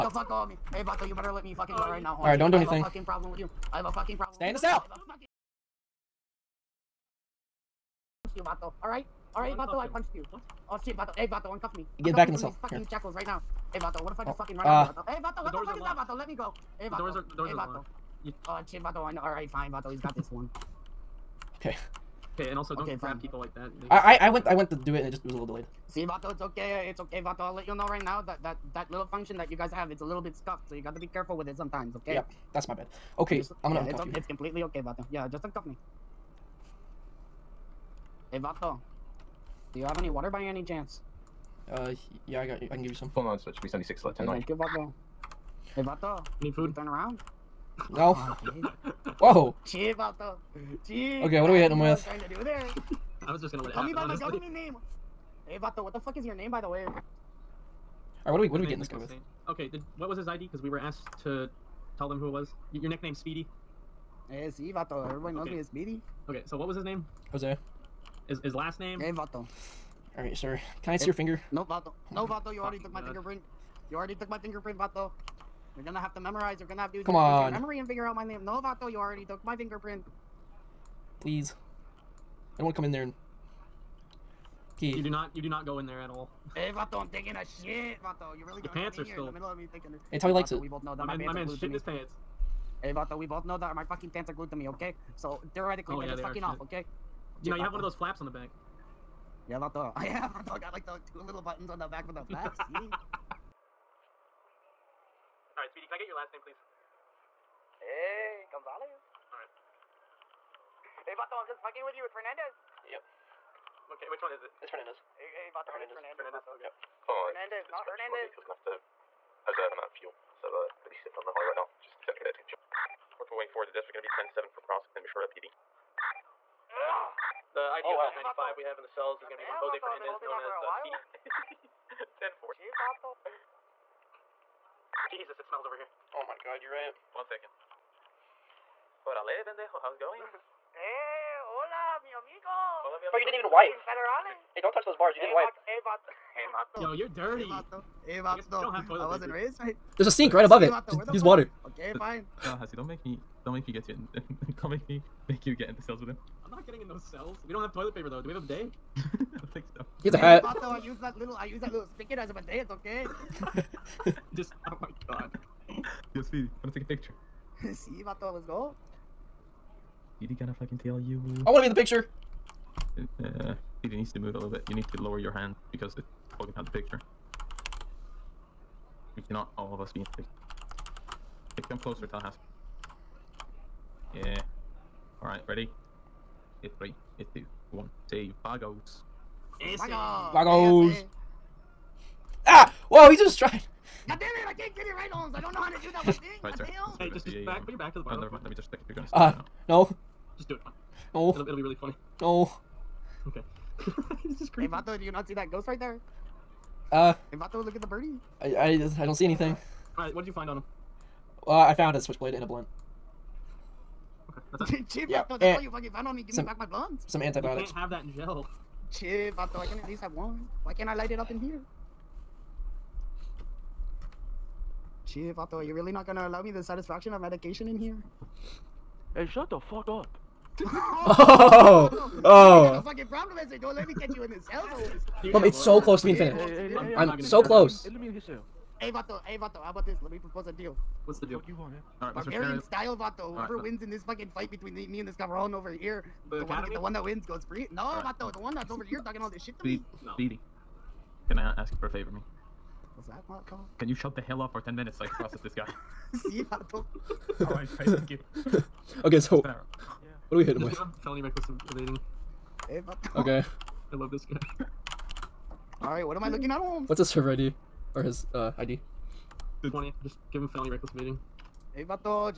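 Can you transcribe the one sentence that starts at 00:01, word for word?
you better let me fucking go right now.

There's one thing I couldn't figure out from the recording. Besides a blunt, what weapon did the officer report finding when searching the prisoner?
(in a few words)
Switchblade.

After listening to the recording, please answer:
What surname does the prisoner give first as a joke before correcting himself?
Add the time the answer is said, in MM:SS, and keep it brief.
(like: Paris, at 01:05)
Gonzalez, at 01:48.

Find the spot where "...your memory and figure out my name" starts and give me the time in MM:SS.
01:17.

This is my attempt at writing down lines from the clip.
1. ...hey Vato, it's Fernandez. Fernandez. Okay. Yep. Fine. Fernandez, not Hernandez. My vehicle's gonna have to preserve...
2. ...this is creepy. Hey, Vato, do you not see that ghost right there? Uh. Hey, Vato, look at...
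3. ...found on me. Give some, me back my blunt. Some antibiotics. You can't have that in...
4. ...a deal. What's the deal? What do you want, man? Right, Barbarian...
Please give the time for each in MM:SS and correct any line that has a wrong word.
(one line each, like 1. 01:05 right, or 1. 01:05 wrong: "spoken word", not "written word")
1. 01:55 right
2. 03:24 right
3. 03:35 right
4. 04:00 right.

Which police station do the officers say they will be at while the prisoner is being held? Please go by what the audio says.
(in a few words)
Mission Row PD.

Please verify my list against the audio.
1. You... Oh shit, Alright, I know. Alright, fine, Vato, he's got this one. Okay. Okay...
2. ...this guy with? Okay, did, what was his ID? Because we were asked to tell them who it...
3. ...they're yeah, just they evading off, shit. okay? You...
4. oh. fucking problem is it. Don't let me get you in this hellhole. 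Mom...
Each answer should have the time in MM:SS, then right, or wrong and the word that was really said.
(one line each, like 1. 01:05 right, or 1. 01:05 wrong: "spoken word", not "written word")
1. 00:18 wrong: "Vato", not "Alright"
2. 00:58 right
3. 01:36 wrong: "fucking", not "evading"
4. 03:52 right.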